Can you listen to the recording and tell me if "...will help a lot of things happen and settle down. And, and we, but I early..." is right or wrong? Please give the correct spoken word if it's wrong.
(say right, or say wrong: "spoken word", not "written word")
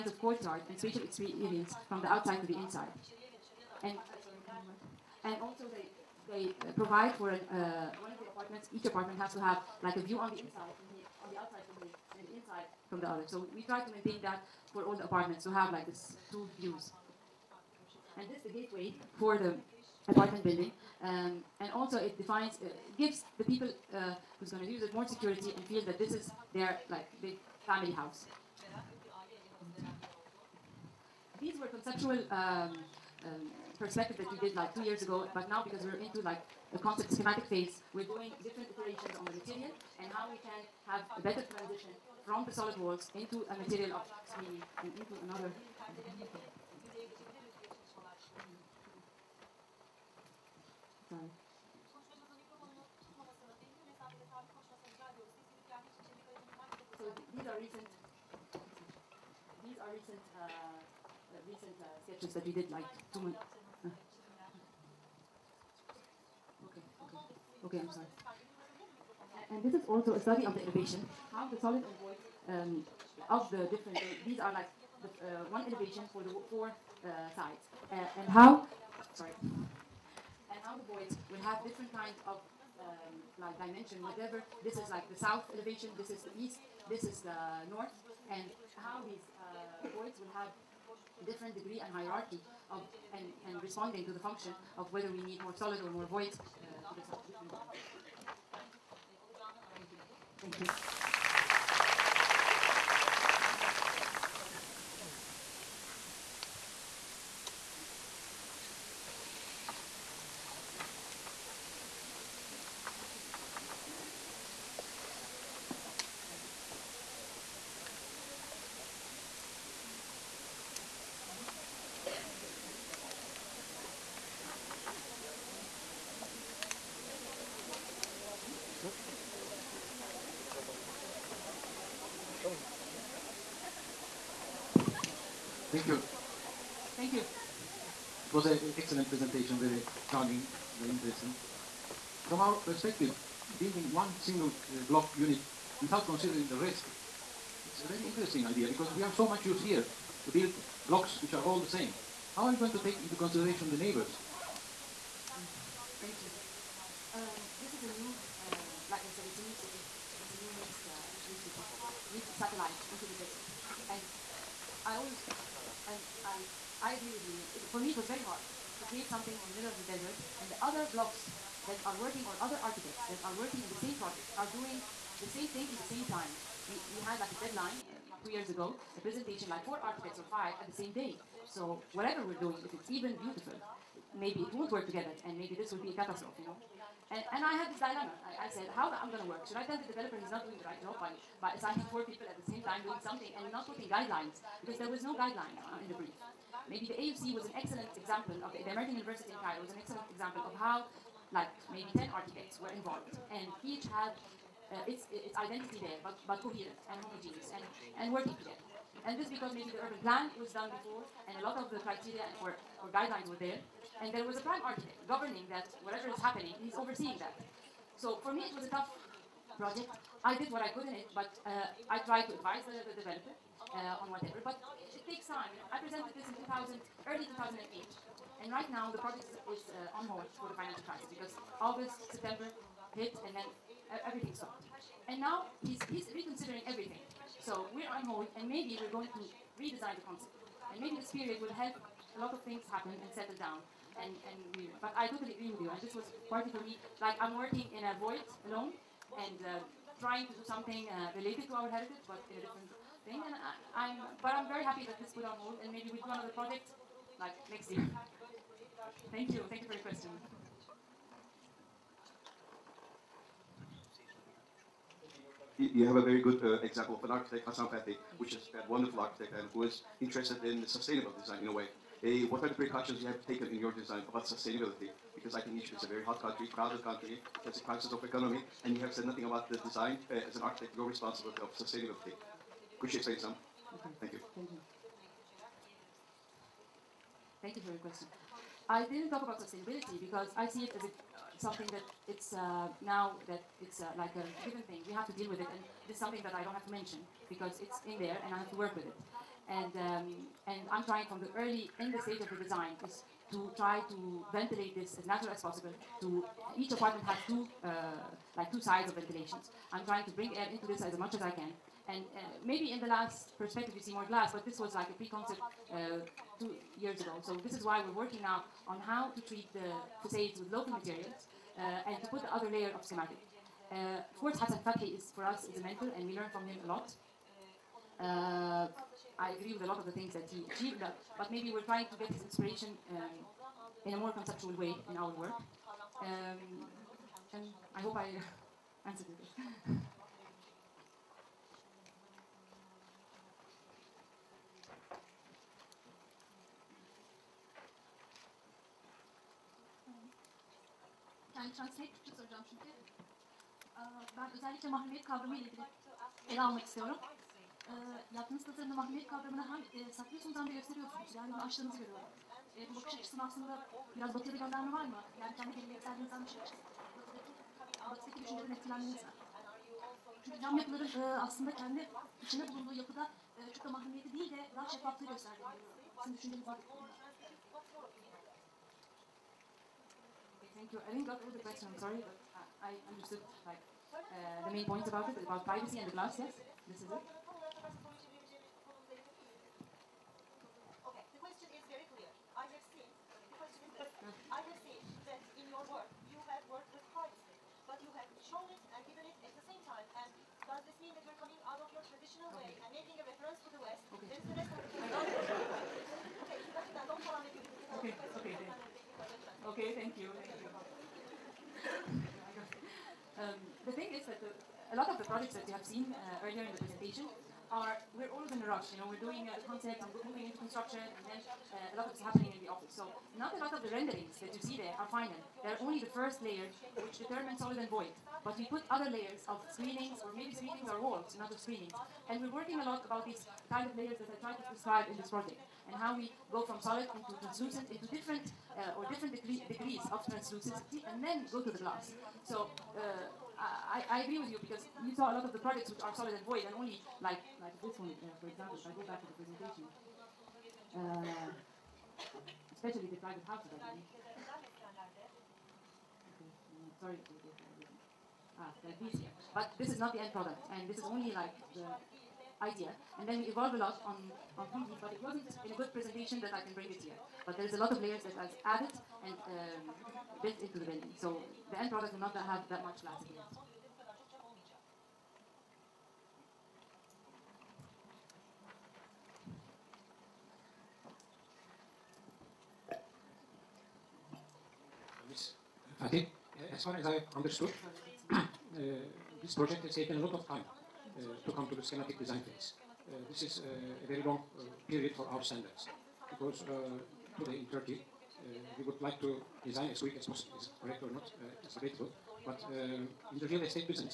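wrong: "totally", not "early".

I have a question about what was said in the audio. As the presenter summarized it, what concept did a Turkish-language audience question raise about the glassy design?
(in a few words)
privacy.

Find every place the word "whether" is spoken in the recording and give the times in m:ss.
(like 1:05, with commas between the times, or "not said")
1:34.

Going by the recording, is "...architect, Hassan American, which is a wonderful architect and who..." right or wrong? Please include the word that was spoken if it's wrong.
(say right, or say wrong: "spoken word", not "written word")
wrong: "Fathy", not "American".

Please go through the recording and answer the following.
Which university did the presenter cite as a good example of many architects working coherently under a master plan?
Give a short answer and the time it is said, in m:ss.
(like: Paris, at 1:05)
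American University in Cairo, at 3:18.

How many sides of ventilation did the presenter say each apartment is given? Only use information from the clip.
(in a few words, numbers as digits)
2.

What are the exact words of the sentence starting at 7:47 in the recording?
But there is a lot of layers that I've added and um, built into the building.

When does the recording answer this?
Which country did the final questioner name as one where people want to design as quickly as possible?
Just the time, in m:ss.
8:17.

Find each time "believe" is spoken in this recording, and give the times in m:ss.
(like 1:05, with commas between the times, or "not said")
7:33.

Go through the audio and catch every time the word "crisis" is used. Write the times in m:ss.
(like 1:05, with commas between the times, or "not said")
3:50, 4:37.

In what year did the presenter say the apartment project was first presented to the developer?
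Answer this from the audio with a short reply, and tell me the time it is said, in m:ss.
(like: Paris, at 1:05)
2008, at 3:47.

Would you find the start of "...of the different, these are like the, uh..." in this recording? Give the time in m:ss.
1:13.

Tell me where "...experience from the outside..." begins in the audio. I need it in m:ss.
0:01.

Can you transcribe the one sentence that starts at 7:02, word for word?
So not a lot of the renderings that you see there are final.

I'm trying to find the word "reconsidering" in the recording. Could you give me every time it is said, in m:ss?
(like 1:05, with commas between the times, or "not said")
3:56.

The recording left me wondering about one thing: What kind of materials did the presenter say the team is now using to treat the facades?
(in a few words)
local materials.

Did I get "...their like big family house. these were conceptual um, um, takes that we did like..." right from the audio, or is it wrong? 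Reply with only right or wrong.
wrong.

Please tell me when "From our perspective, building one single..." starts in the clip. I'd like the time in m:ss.
2:22.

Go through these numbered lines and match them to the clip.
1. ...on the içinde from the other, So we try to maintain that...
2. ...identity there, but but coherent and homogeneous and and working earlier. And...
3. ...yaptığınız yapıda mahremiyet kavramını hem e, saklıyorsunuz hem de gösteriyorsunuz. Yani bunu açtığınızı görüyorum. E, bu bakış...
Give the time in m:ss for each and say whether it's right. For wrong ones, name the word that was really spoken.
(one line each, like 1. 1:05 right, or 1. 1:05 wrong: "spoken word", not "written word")
1. 0:10 wrong: "inside", not "içinde"
2. 3:25 wrong: "together", not "earlier"
3. 5:58 wrong: "tasarımda", not "yapıda".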